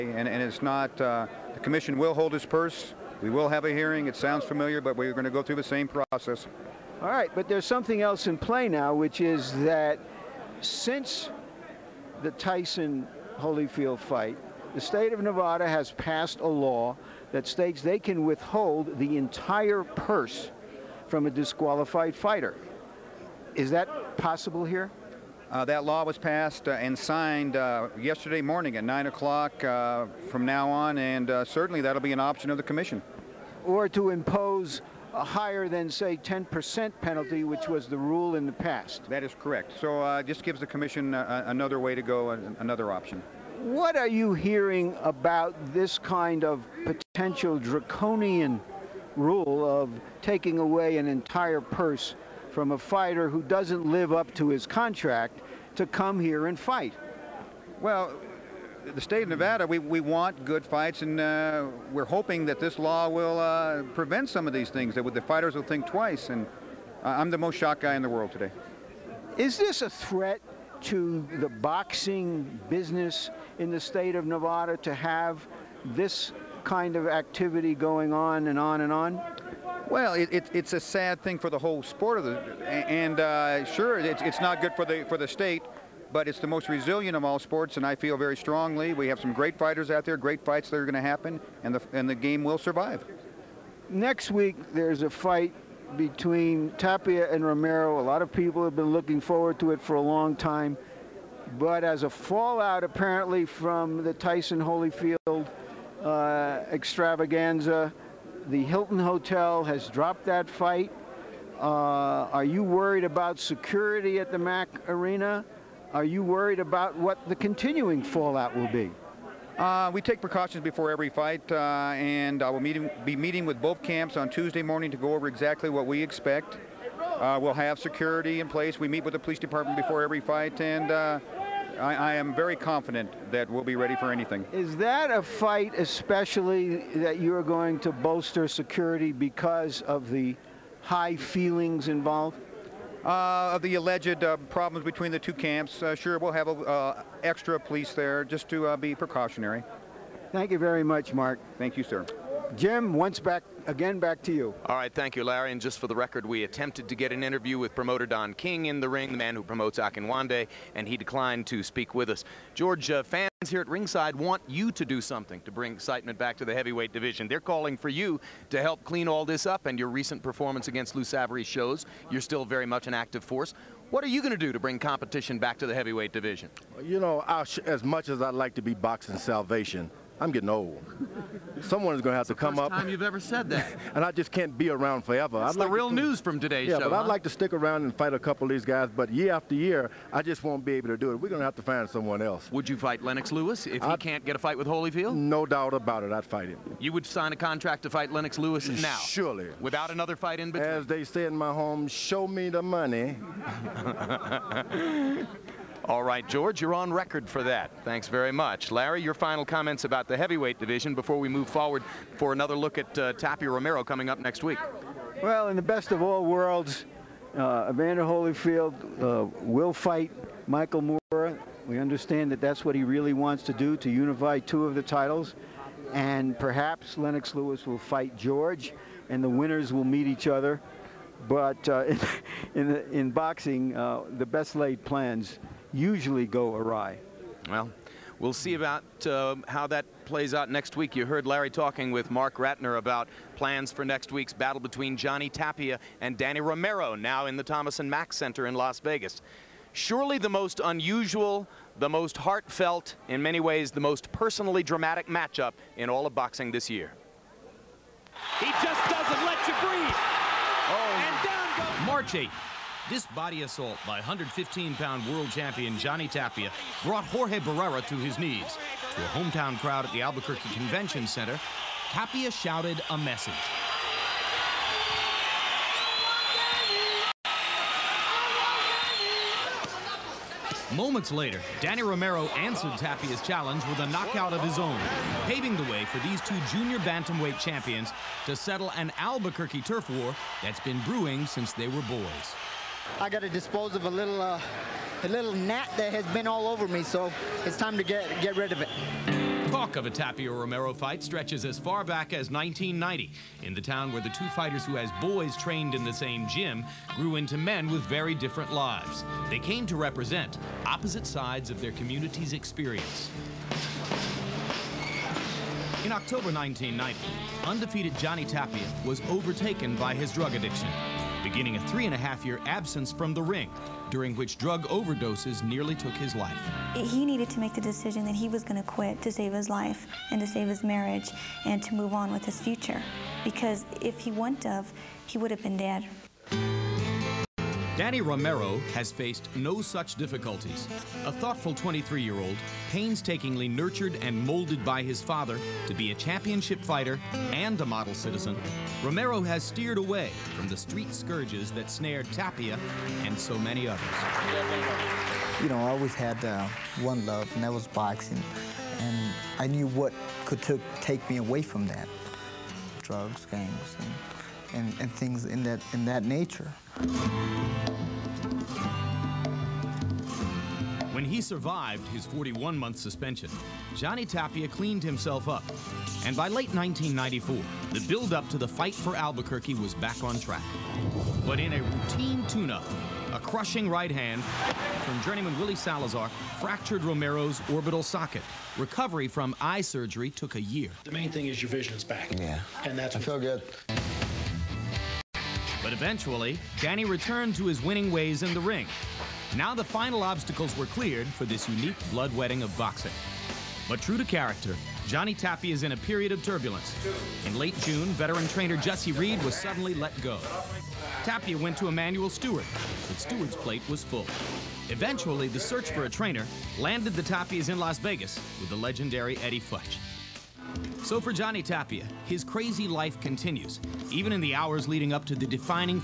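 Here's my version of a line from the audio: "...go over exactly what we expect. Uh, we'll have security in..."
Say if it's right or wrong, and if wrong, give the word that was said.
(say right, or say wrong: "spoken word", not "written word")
right.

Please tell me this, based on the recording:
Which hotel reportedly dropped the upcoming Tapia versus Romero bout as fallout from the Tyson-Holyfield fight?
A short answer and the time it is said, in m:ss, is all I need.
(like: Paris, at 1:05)
Hilton Hotel, at 1:48.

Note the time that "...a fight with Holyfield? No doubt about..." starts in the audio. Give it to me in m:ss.
3:14.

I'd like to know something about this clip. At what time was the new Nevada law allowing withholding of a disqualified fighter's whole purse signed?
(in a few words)
9 o'clock.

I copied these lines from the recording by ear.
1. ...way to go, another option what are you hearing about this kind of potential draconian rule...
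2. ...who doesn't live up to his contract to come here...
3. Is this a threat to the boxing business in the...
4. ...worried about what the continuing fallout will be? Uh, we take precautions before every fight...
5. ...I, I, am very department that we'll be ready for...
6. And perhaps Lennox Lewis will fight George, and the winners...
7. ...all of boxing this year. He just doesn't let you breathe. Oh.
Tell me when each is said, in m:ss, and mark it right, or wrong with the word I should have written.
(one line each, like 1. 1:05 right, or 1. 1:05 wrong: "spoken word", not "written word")
1. 0:41 right
2. 0:53 right
3. 1:09 right
4. 1:56 right
5. 2:11 wrong: "confident", not "department"
6. 3:45 right
7. 4:15 right.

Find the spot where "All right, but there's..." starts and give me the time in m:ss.
0:07.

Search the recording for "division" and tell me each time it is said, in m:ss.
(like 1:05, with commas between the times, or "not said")
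2:46, 2:56, 3:30.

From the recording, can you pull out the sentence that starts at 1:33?
Next week, there's a fight between Tapia and Romero.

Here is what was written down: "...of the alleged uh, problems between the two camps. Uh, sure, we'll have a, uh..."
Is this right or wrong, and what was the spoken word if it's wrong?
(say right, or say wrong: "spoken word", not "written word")
right.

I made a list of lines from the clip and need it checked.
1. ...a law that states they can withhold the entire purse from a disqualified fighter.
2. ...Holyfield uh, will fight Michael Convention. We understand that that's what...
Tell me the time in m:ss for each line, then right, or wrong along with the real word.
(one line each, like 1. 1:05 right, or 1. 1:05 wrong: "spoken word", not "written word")
1. 0:16 right
2. 3:38 wrong: "Moorer", not "Convention".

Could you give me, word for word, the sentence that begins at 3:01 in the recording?
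Someone is going to have to come first up.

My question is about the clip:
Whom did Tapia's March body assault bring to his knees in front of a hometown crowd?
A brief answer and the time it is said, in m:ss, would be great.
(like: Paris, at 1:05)
Jorge Barrera, at 4:27.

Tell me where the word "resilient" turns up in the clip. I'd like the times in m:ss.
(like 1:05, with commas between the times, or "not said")
1:26.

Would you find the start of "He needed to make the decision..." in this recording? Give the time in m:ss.
5:26.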